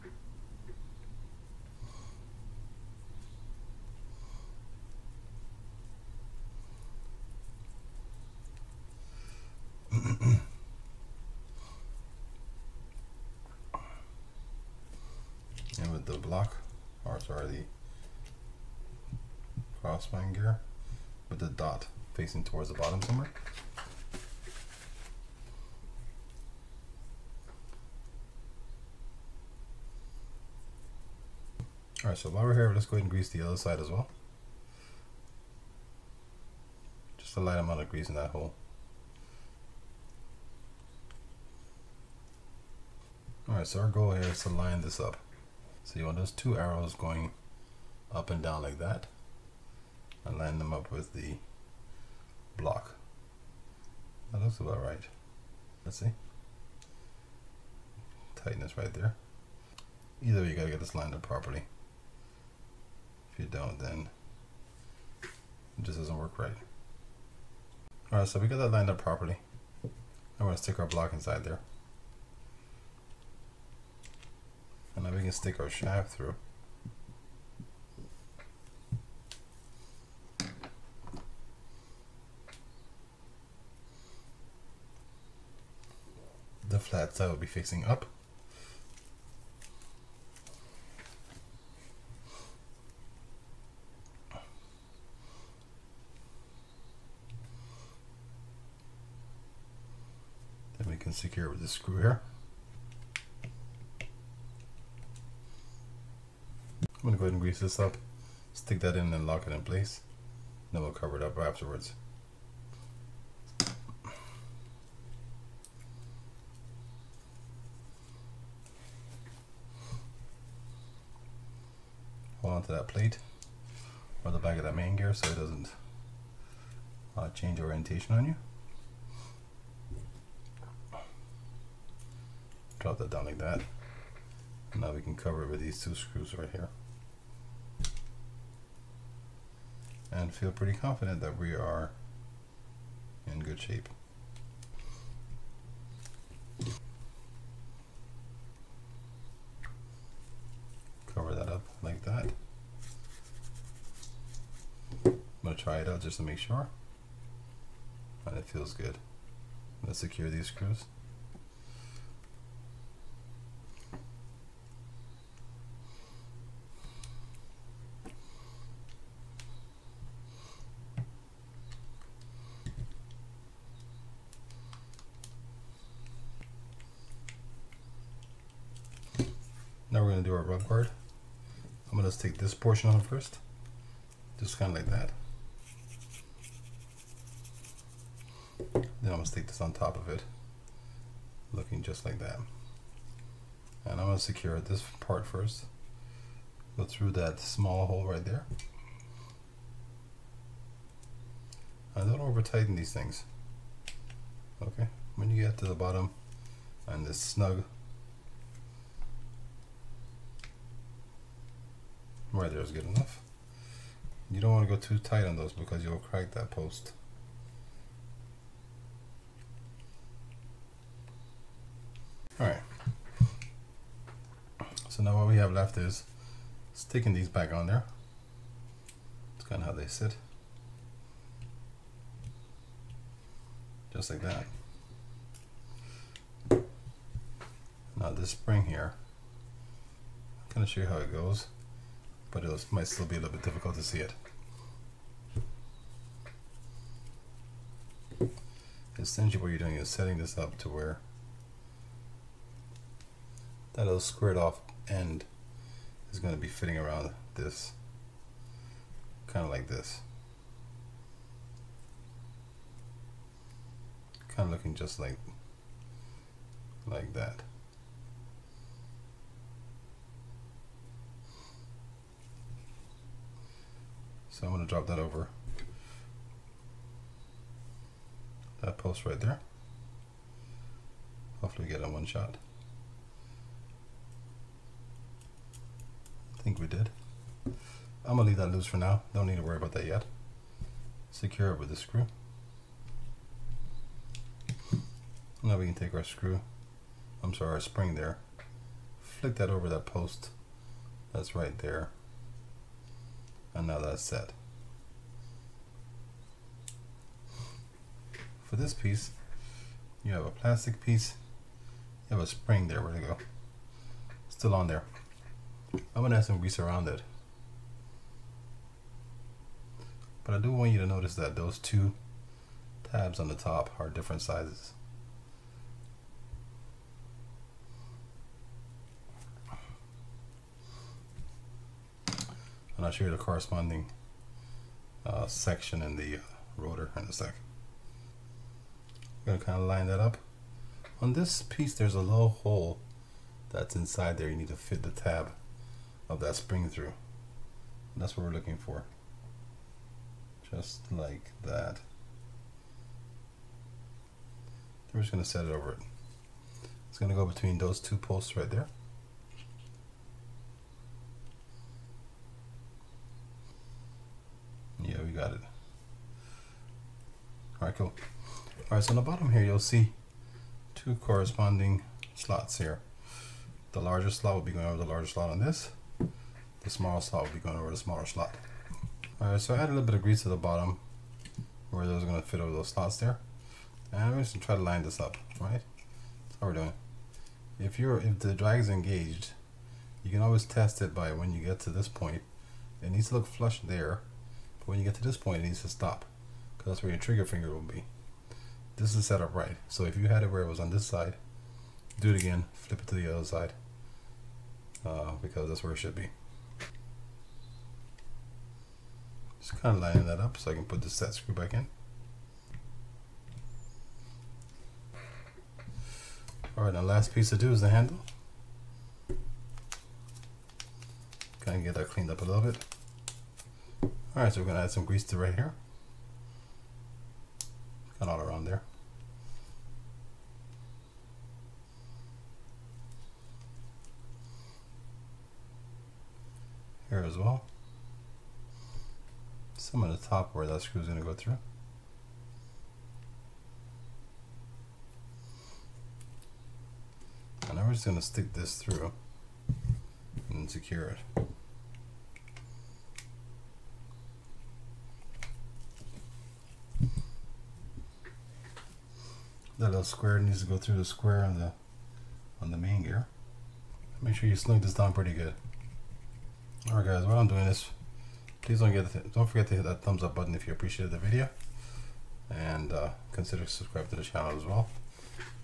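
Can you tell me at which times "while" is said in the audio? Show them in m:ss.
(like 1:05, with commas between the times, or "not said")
0:32, 7:47.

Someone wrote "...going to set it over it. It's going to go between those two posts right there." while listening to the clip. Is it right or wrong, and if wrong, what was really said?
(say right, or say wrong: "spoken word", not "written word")
right.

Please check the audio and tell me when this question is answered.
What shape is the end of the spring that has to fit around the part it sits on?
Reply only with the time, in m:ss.
4:13.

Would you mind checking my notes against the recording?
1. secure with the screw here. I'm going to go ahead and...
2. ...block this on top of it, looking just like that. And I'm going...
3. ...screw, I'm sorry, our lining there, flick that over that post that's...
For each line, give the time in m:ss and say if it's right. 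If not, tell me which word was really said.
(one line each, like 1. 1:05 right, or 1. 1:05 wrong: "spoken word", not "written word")
1. 1:41 right
2. 3:09 wrong: "stick", not "block"
3. 4:56 wrong: "spring", not "lining".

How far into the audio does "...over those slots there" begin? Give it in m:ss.
6:22.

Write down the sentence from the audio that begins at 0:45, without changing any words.
So you want those two arrows going up and down like that and line them up with the block.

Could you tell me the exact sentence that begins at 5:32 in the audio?
and I'll show you the corresponding uh, section in the uh, rotor in a sec.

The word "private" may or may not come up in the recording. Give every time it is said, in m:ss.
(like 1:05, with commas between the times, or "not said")
not said.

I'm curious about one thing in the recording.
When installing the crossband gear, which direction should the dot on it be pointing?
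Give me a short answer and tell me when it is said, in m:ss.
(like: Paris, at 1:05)
Towards the bottom, at 0:21.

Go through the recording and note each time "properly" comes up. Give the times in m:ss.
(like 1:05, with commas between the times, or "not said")
1:01, 1:08.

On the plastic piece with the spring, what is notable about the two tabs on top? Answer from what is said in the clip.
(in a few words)
Different sizes.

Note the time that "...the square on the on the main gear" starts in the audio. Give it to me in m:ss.
7:40.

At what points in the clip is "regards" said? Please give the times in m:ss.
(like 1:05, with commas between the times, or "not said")
not said.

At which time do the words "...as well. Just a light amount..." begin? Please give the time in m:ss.
0:33.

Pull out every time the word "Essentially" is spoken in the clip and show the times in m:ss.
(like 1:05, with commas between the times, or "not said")
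4:08.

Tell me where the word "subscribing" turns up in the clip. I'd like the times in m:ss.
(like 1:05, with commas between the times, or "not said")
7:53.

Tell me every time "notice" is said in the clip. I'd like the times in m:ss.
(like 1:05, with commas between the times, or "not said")
5:20.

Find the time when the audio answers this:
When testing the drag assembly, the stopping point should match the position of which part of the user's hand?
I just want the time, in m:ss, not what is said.
6:36.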